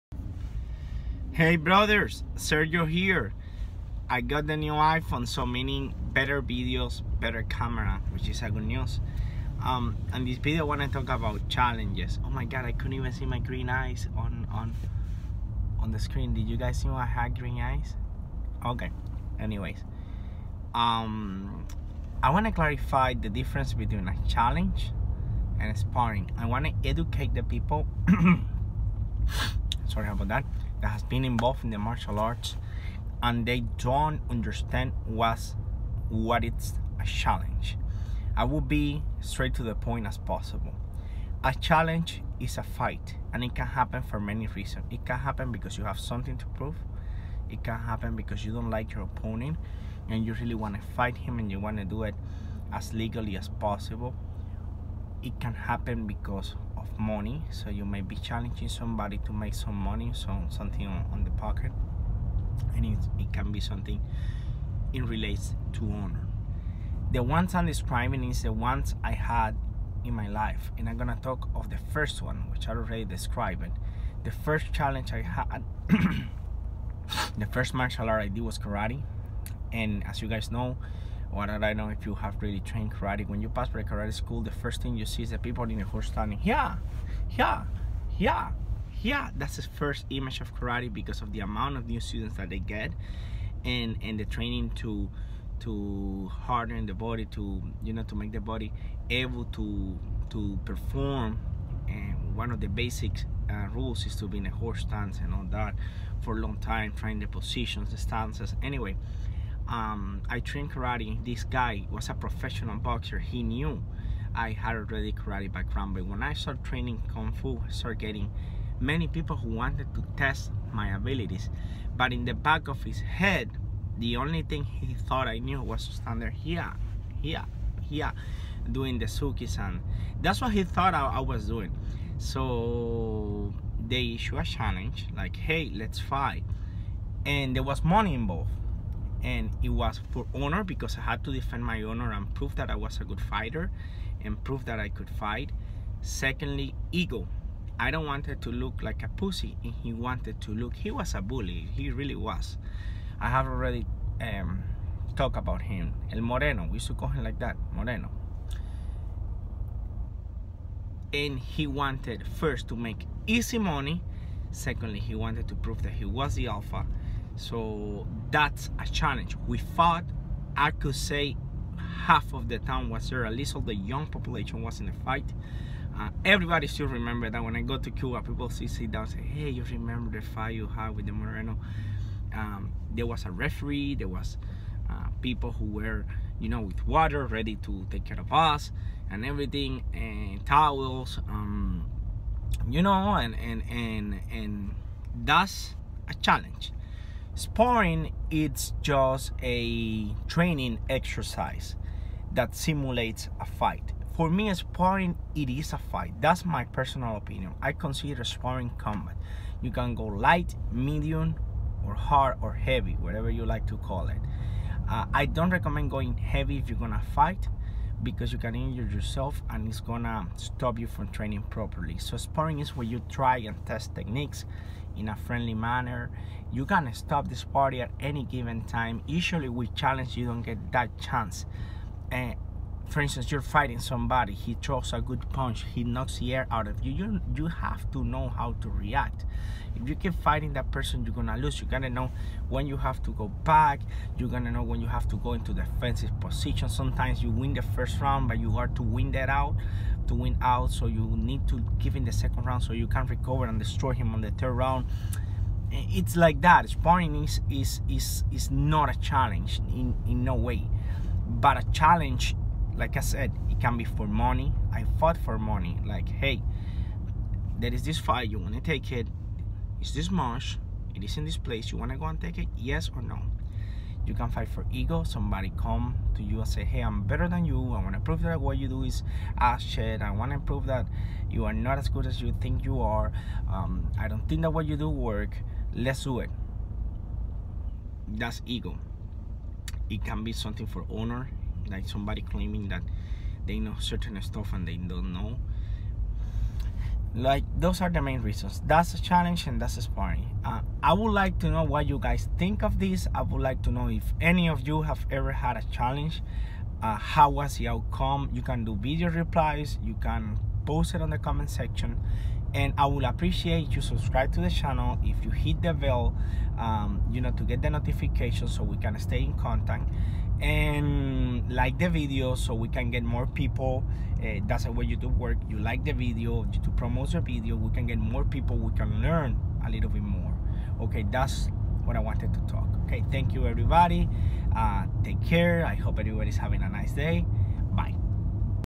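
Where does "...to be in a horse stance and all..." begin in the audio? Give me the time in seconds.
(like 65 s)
104 s.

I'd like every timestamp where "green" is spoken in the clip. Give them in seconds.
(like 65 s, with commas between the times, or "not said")
13 s, 17 s.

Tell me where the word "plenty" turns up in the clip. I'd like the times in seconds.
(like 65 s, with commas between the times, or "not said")
not said.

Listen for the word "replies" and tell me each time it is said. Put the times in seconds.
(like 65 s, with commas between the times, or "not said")
309 s.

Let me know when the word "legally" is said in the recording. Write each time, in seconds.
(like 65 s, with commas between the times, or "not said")
52 s.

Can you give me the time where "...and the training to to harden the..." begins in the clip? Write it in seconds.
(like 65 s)
94 s.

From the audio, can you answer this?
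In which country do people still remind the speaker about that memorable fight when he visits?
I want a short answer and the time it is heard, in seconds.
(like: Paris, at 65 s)
Cuba, at 177 s.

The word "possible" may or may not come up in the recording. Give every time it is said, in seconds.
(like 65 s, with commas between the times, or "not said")
40 s, 53 s.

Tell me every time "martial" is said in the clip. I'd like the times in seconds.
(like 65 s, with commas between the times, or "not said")
31 s, 77 s.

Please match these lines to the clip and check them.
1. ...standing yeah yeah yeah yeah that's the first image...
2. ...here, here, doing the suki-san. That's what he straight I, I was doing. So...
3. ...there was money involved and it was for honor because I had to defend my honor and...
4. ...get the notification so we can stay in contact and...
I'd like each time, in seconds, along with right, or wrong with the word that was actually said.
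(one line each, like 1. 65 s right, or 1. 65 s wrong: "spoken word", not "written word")
1. 86 s right
2. 127 s wrong: "thought", not "straight"
3. 137 s right
4. 317 s right.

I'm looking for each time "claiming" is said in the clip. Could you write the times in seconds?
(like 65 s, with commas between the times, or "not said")
292 s.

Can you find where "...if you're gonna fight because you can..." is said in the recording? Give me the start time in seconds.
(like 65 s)
216 s.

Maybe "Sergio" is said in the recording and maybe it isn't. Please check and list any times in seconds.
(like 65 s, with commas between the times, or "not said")
2 s.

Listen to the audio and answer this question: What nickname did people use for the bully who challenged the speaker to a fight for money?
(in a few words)
El Moreno.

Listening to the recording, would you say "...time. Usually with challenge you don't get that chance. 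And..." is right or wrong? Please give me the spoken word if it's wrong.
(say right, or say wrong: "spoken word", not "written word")
right.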